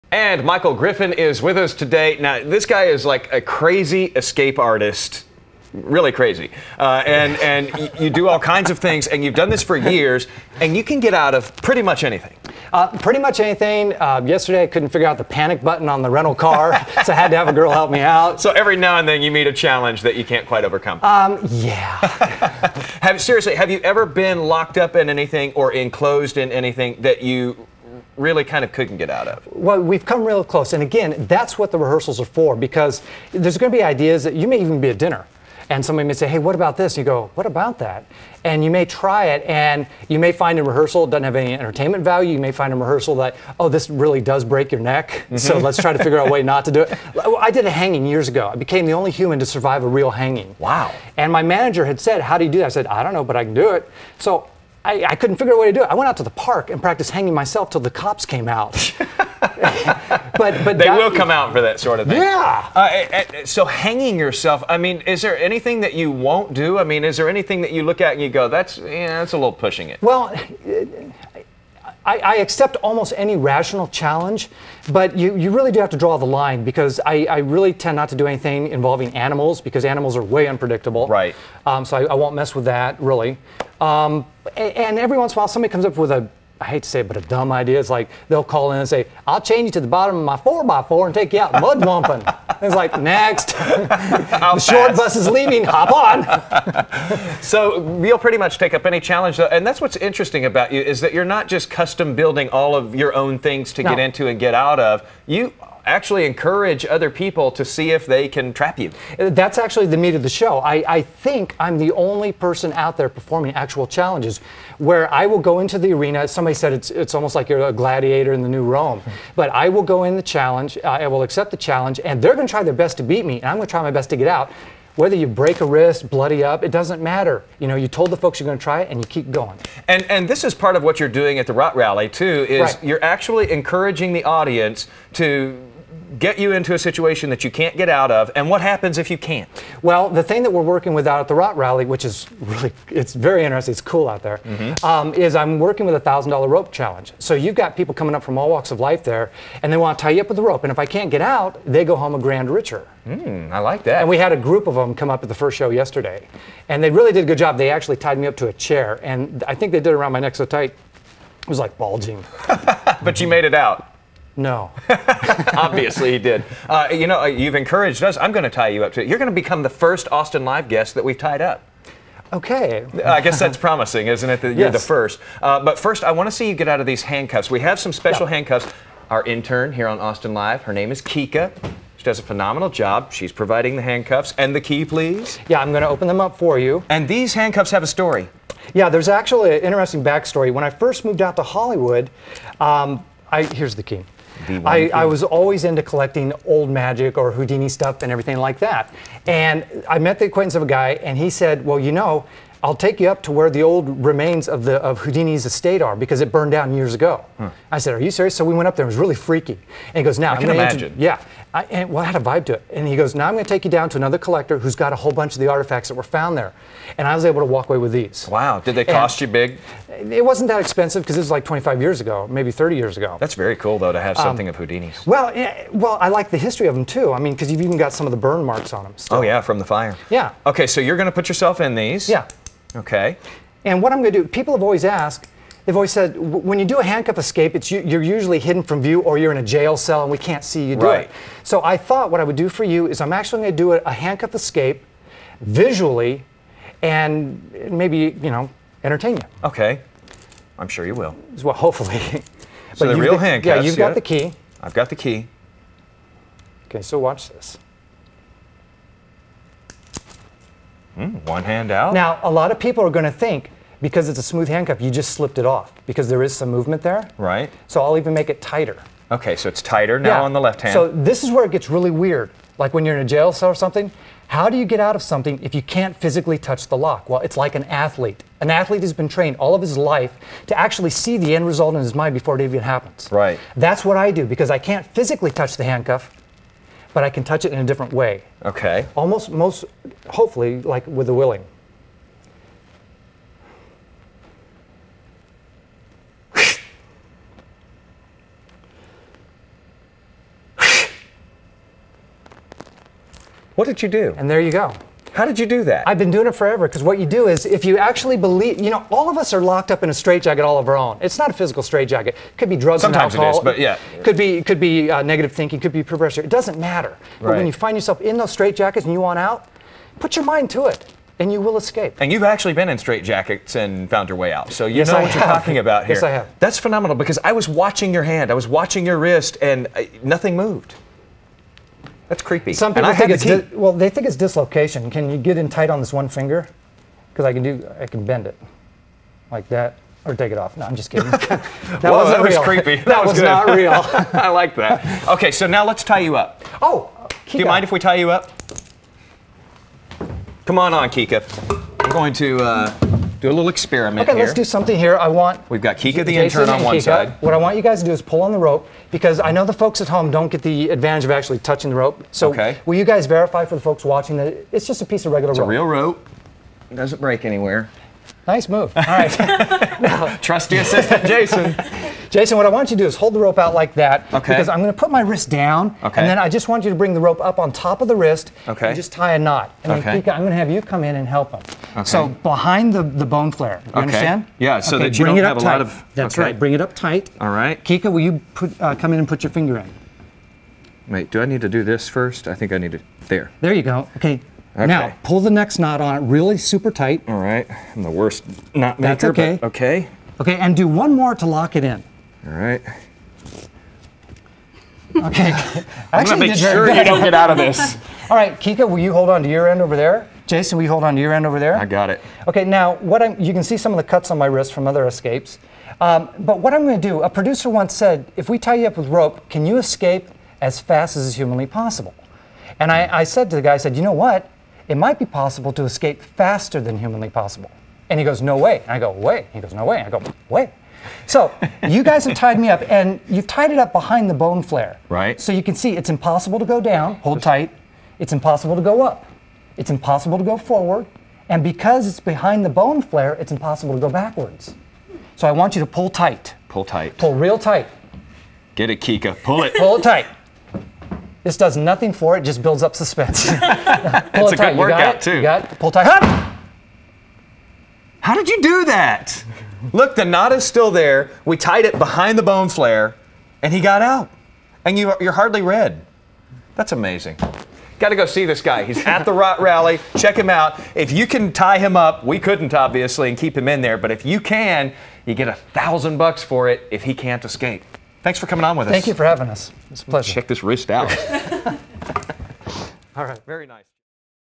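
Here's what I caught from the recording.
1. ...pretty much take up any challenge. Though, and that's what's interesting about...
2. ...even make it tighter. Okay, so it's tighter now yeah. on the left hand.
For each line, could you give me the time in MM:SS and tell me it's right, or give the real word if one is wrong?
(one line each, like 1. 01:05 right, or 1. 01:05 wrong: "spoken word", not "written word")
1. 01:38 right
2. 04:27 right.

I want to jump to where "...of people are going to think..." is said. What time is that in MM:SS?
04:22.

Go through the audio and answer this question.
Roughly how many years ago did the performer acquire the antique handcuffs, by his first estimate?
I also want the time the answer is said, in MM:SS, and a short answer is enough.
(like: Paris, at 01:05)
25, at 03:41.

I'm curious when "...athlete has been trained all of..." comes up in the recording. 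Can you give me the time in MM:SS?
04:38.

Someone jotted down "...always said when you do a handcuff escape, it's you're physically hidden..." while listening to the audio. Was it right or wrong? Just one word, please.
wrong.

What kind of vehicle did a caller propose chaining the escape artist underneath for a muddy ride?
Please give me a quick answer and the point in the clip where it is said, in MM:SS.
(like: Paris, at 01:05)
4x4, at 01:30.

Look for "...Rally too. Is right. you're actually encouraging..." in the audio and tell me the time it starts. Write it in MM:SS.
02:11.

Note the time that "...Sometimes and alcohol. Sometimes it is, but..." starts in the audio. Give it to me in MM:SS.
05:12.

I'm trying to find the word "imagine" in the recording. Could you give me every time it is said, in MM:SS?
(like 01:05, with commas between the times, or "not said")
03:30.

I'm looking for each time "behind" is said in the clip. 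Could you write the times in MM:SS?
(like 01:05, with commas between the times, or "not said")
06:22, 07:13, 07:21, 07:41.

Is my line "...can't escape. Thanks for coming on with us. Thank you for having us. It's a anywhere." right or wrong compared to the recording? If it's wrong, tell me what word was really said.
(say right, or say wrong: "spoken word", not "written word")
wrong: "pleasure", not "anywhere".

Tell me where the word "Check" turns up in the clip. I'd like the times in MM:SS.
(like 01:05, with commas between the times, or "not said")
07:49, 08:00.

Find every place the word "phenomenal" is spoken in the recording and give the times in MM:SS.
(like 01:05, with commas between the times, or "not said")
03:02, 05:26.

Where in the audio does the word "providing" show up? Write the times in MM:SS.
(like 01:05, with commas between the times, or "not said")
03:03.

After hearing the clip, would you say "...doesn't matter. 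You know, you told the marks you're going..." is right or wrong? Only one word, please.
wrong.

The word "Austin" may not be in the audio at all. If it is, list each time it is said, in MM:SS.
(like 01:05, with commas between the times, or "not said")
02:50, 02:59.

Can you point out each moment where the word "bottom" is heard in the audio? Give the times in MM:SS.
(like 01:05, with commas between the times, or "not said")
01:29.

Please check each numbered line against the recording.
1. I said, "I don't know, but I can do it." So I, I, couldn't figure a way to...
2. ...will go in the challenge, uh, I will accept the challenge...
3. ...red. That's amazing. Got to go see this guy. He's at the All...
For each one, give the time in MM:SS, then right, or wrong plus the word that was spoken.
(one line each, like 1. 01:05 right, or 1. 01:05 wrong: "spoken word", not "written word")
1. 00:52 right
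2. 01:59 right
3. 07:45 wrong: "Rot", not "All".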